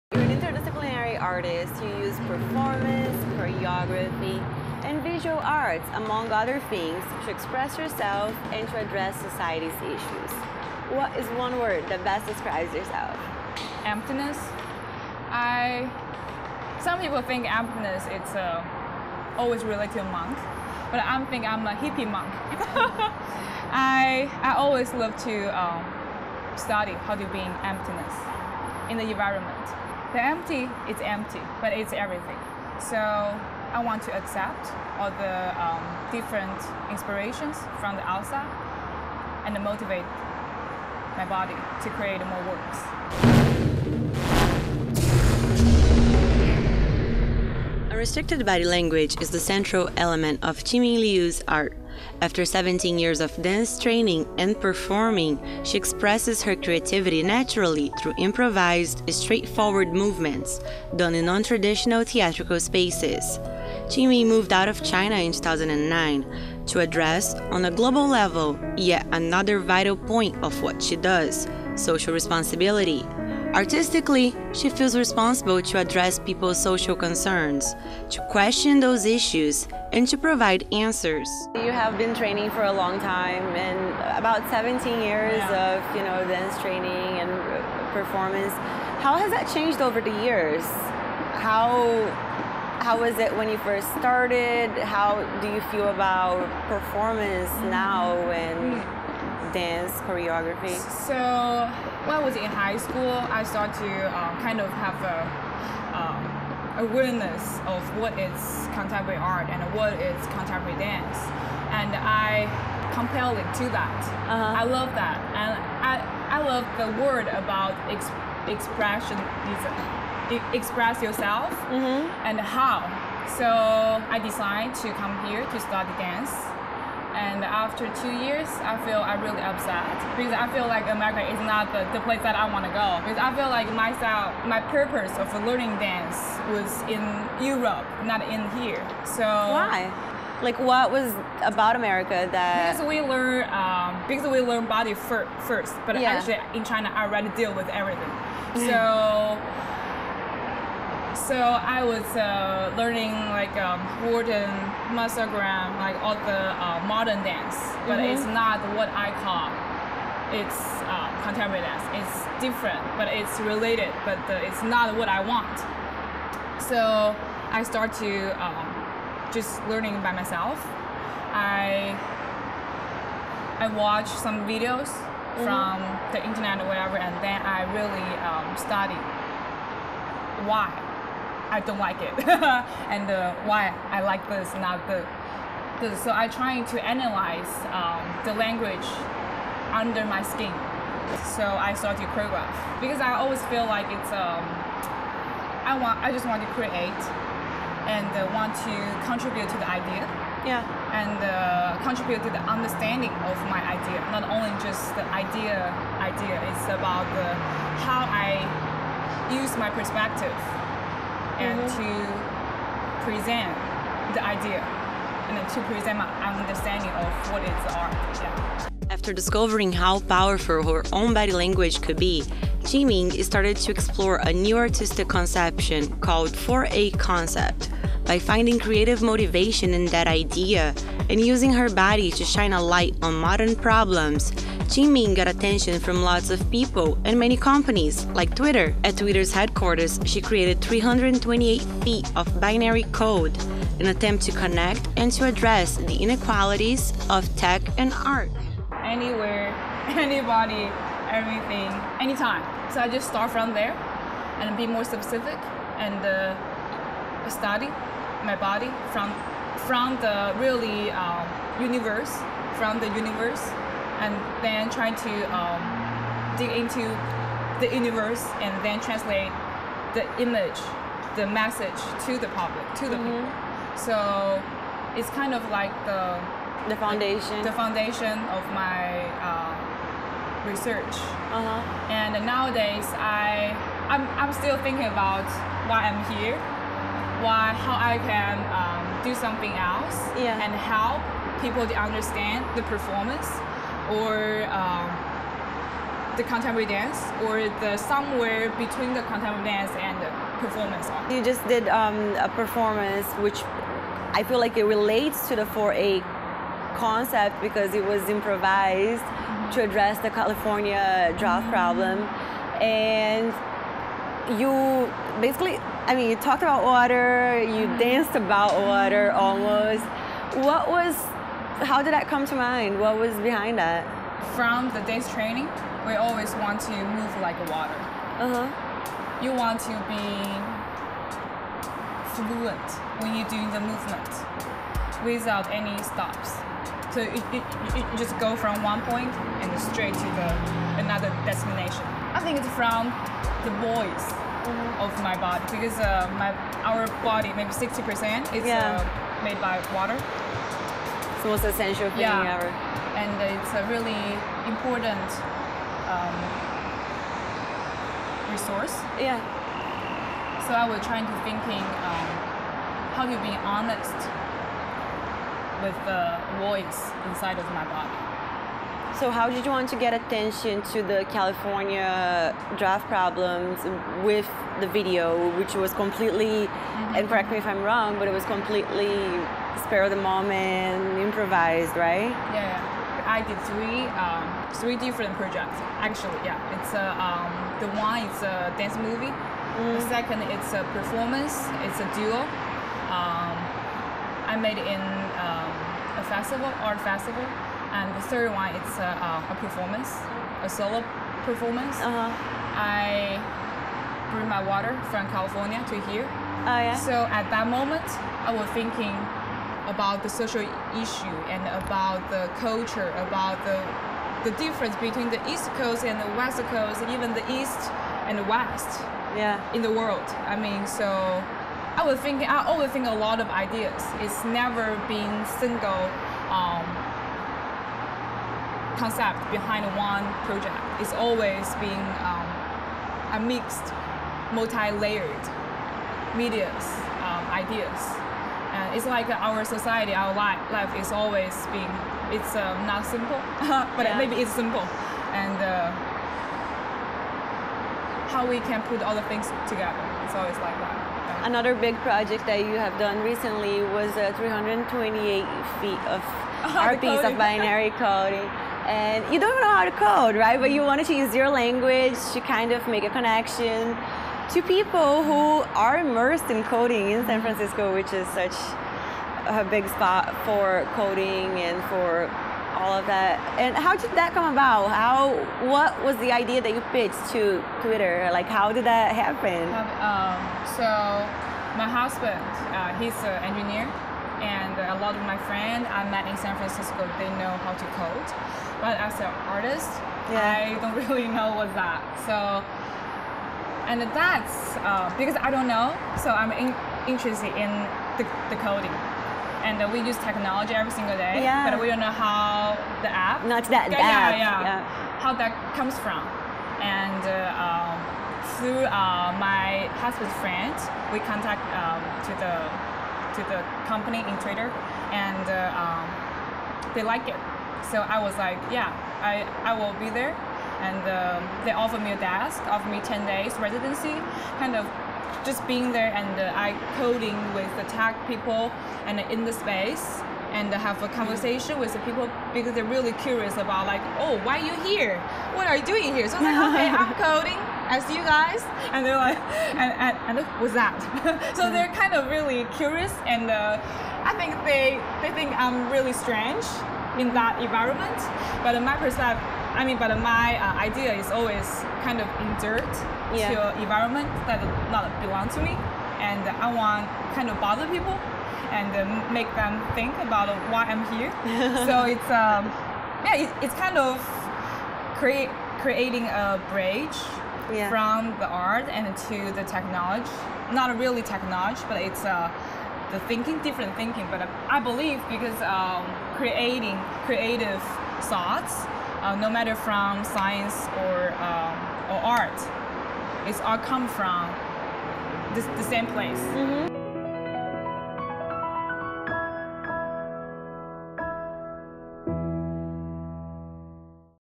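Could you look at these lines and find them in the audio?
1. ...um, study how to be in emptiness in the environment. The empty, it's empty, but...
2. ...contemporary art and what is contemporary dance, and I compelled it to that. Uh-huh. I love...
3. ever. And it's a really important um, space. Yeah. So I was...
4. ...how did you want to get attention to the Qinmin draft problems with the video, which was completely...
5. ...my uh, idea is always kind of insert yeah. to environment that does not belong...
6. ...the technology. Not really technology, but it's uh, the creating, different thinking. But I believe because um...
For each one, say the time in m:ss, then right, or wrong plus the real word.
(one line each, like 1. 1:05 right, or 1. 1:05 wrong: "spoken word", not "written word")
1. 0:25 right
2. 1:48 right
3. 5:52 wrong: "resource", not "space"
4. 6:09 wrong: "California", not "Qinmin"
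5. 9:09 right
6. 9:29 wrong: "thinking", not "creating".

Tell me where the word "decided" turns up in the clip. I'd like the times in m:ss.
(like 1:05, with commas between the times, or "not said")
2:04.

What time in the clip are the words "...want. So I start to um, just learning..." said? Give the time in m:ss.
2:45.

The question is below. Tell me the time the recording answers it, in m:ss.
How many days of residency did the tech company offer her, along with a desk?
8:42.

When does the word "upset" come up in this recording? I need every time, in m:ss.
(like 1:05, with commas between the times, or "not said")
2:09.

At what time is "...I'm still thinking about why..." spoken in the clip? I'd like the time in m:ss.
4:44.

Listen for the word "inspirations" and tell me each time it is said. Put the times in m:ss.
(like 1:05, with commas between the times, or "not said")
0:36.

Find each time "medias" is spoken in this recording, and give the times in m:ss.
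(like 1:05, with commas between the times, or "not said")
7:16.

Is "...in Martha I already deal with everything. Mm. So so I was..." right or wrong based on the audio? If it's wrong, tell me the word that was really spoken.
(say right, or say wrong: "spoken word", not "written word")
wrong: "China", not "Martha".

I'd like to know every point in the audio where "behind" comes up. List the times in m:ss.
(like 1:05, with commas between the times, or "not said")
5:23, 7:09.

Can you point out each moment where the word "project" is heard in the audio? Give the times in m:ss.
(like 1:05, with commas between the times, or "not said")
6:25, 7:10, 7:31.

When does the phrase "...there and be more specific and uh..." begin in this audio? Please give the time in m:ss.
4:13.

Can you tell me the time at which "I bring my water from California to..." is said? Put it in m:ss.
6:42.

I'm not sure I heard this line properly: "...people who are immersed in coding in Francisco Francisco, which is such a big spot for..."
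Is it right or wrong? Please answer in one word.
wrong.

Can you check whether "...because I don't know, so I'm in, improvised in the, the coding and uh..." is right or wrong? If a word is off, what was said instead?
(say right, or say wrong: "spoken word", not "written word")
wrong: "interested", not "improvised".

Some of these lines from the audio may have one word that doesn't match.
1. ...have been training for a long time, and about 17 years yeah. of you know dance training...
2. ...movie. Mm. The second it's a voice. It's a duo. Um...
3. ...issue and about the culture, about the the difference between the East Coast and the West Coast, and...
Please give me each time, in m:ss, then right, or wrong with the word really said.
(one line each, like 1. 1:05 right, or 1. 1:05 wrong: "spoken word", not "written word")
1. 1:21 right
2. 6:28 wrong: "performance", not "voice"
3. 6:50 right.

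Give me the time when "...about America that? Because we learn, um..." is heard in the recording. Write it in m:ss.
2:21.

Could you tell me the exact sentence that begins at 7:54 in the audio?
How what was the idea that you pitched to Twitter?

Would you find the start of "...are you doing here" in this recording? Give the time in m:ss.
8:55.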